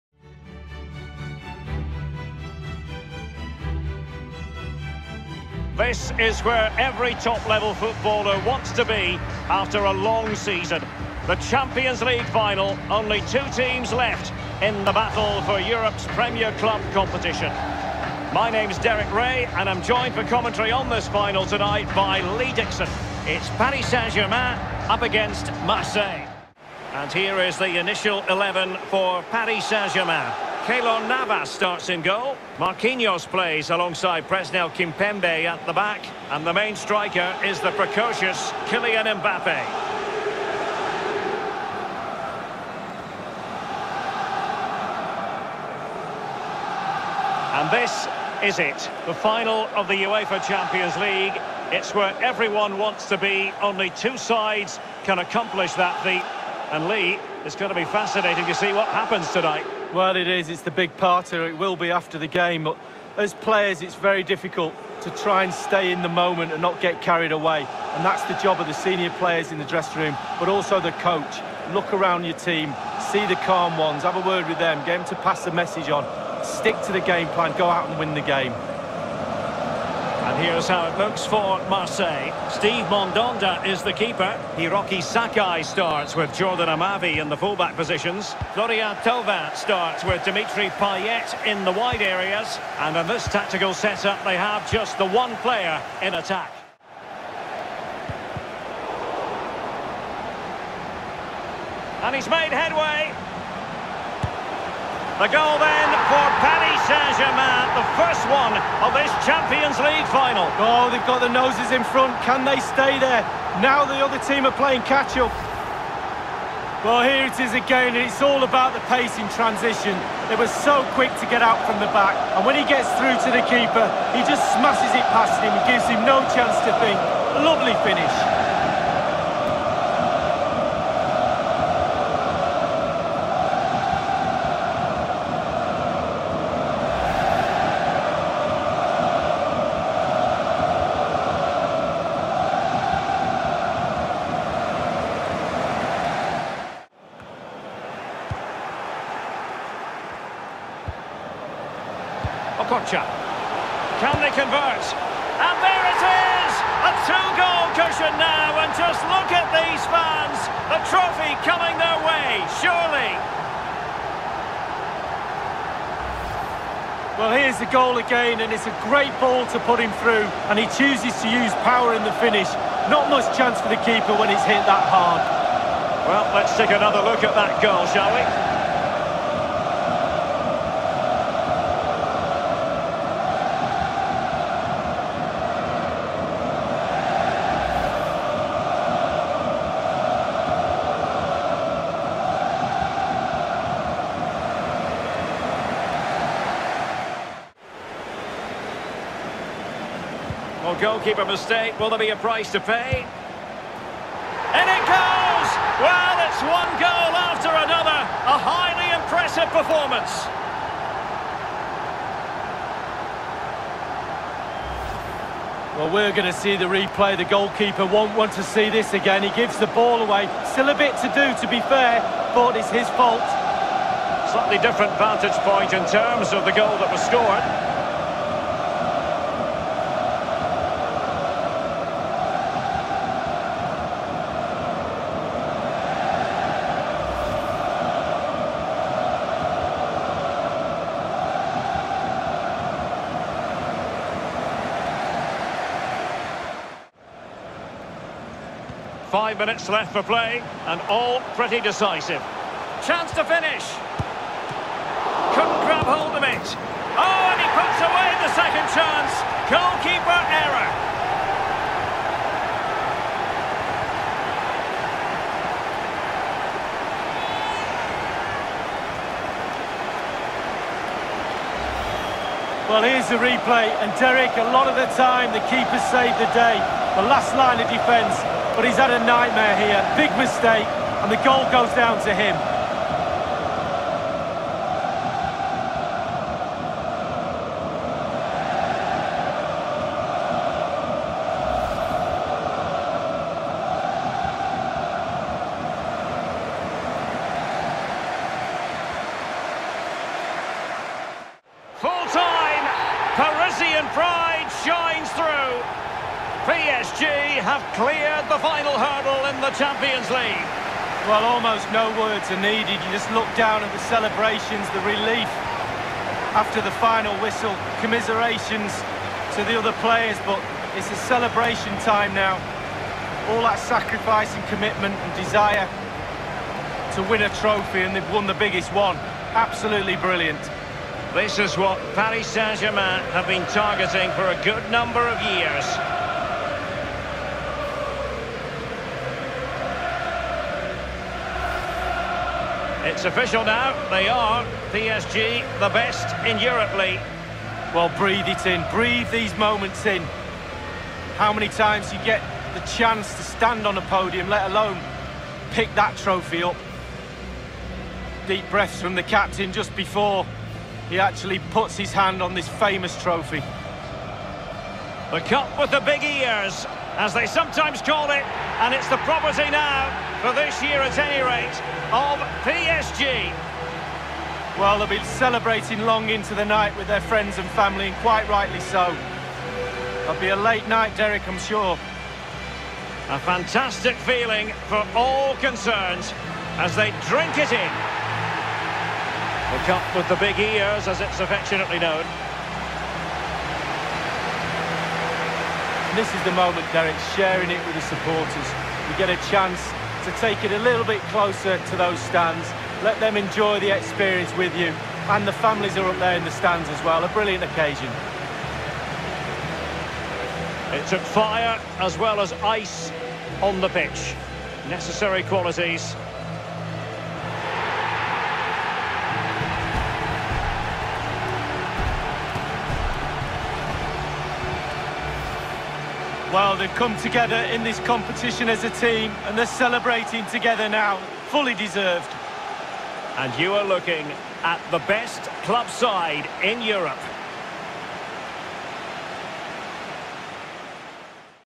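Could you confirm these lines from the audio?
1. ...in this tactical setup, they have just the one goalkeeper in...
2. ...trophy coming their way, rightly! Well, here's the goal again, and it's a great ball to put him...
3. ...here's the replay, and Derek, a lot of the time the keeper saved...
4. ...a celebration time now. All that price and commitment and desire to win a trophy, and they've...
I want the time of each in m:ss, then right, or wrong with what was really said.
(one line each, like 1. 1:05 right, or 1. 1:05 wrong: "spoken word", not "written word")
1. 1:32 wrong: "player", not "goalkeeper"
2. 2:40 wrong: "surely", not "rightly"
3. 4:32 right
4. 5:20 wrong: "sacrifice", not "price".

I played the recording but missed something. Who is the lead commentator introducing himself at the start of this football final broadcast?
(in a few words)
Derek Ray.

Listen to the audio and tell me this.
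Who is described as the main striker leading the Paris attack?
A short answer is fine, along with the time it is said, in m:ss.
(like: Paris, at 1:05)
Kylian Mbappe, at 0:38.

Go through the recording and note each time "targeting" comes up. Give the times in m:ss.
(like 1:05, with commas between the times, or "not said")
5:33.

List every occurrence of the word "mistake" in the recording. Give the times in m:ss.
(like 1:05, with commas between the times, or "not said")
3:21, 4:40.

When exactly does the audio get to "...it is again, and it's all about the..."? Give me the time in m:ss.
1:57.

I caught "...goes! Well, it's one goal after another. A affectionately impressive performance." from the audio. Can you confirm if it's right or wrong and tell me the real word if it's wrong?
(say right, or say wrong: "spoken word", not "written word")
wrong: "highly", not "affectionately".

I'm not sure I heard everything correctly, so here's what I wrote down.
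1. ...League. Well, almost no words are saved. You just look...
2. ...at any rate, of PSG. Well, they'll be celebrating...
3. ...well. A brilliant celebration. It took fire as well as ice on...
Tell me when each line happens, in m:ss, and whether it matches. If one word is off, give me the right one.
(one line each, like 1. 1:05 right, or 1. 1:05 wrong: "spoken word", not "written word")
1. 5:10 wrong: "needed", not "saved"
2. 6:10 right
3. 6:46 wrong: "occasion", not "celebration".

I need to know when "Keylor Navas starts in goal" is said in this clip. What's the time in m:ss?
0:30.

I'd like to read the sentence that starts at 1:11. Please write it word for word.
Look around your team, see the calm ones, have a word with them, get them to pass the message on.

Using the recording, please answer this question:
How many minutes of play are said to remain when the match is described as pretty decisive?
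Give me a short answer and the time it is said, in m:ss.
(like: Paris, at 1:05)
5, at 4:09.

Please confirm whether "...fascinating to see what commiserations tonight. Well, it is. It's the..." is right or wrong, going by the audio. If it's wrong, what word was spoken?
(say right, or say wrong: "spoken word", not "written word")
wrong: "happens", not "commiserations".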